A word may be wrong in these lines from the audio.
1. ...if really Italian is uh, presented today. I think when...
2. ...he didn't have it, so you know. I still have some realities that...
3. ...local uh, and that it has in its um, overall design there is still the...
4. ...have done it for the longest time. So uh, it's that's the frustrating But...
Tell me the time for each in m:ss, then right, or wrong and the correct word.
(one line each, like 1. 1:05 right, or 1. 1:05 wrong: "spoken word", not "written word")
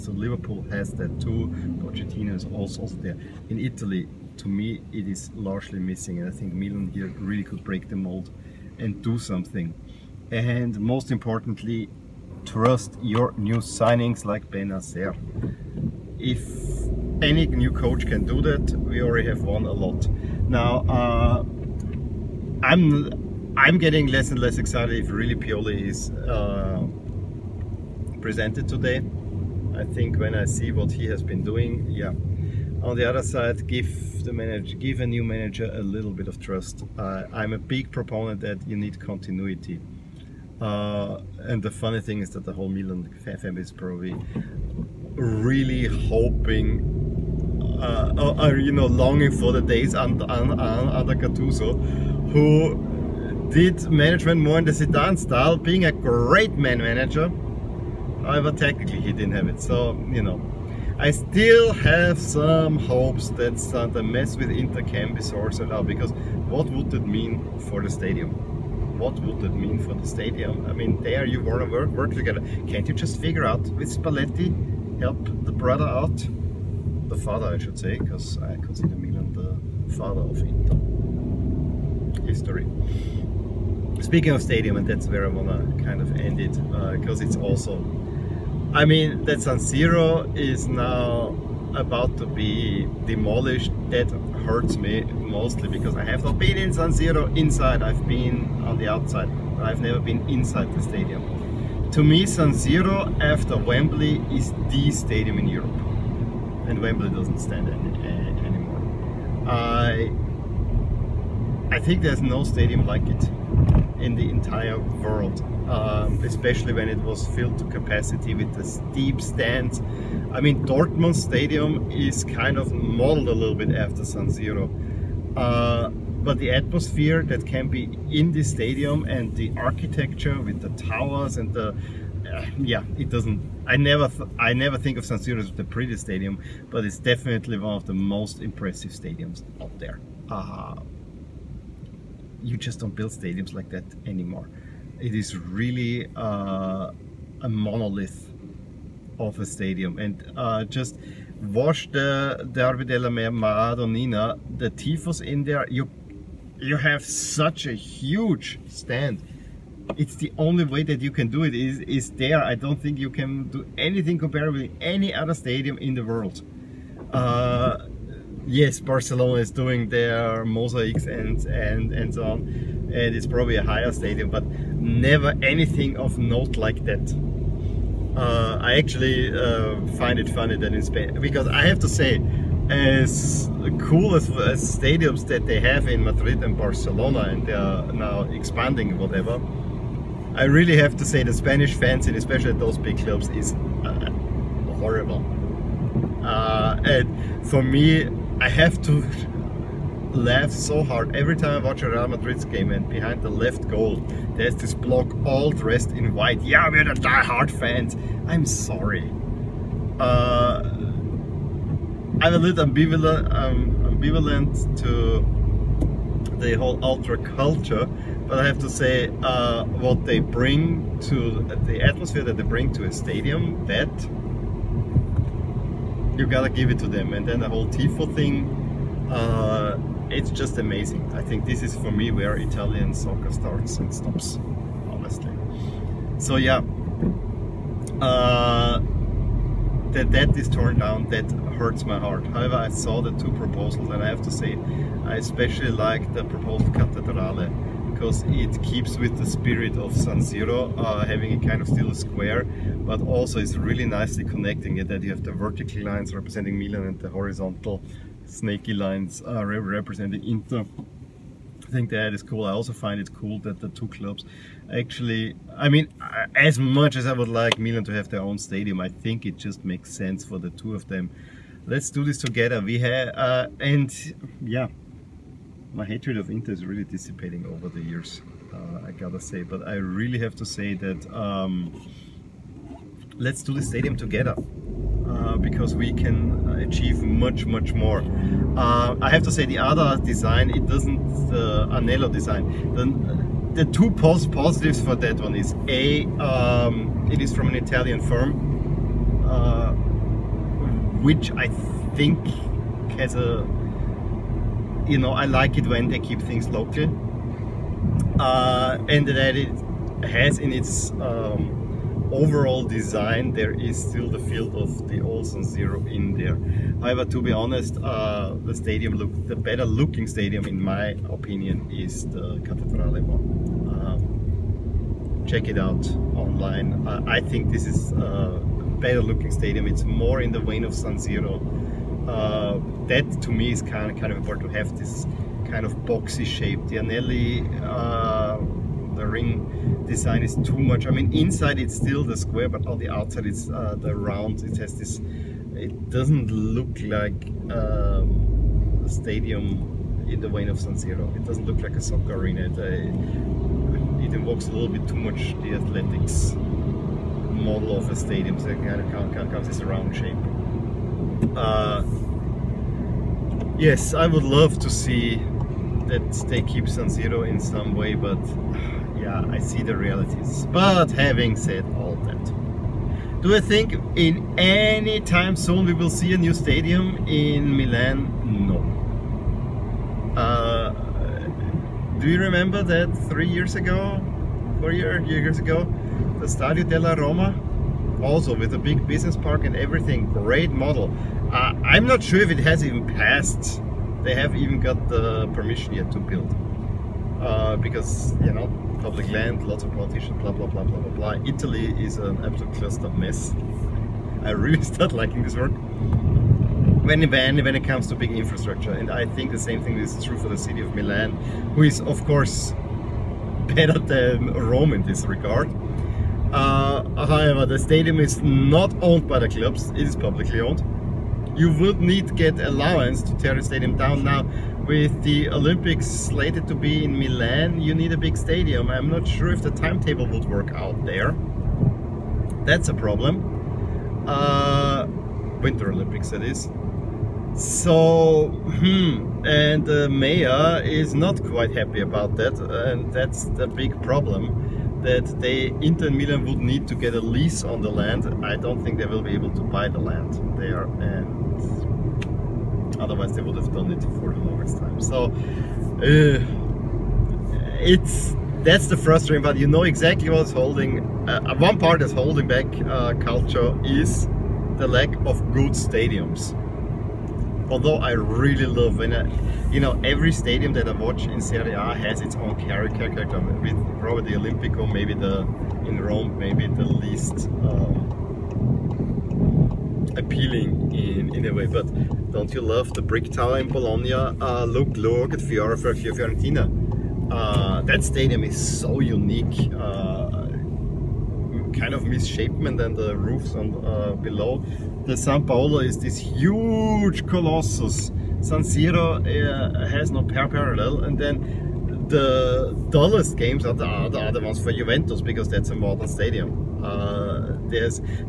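1. 0:25 wrong: "Pioli", not "Italian"
2. 0:58 wrong: "hopes", not "realities"
3. 5:06 right
4. 7:33 right.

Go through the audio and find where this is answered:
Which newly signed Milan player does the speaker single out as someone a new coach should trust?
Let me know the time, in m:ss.
0:14.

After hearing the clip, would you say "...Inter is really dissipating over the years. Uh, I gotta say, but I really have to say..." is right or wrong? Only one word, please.
right.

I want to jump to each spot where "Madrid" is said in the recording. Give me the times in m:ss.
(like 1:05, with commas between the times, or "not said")
3:06, 3:22.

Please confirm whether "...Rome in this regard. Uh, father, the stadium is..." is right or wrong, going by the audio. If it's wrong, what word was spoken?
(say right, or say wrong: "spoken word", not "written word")
wrong: "however", not "father".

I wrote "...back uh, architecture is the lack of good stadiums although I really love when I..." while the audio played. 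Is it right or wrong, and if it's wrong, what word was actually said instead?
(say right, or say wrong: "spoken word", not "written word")
wrong: "culture", not "architecture".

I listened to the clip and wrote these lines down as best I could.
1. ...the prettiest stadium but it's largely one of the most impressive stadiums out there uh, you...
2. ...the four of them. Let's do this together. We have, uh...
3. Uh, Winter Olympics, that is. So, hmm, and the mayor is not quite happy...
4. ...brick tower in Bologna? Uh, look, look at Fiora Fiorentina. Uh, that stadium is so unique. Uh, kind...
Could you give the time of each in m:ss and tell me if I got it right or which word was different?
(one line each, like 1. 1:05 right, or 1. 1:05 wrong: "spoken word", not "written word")
1. 2:15 wrong: "definitely", not "largely"
2. 4:30 wrong: "two", not "four"
3. 7:14 right
4. 8:02 right.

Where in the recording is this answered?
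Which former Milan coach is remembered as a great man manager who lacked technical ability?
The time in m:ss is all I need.
0:51.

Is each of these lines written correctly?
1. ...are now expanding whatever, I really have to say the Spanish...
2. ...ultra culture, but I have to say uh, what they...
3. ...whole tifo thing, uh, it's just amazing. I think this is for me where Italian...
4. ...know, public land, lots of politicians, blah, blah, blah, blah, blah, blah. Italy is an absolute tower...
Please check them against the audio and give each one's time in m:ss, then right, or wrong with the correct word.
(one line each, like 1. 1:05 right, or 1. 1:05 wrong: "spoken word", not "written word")
1. 3:07 right
2. 3:36 right
3. 3:47 right
4. 6:38 wrong: "cluster", not "tower".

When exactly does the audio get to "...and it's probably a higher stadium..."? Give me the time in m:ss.
2:52.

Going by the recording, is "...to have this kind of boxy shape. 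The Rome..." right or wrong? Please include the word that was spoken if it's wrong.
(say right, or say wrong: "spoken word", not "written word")
wrong: "Anelli", not "Rome".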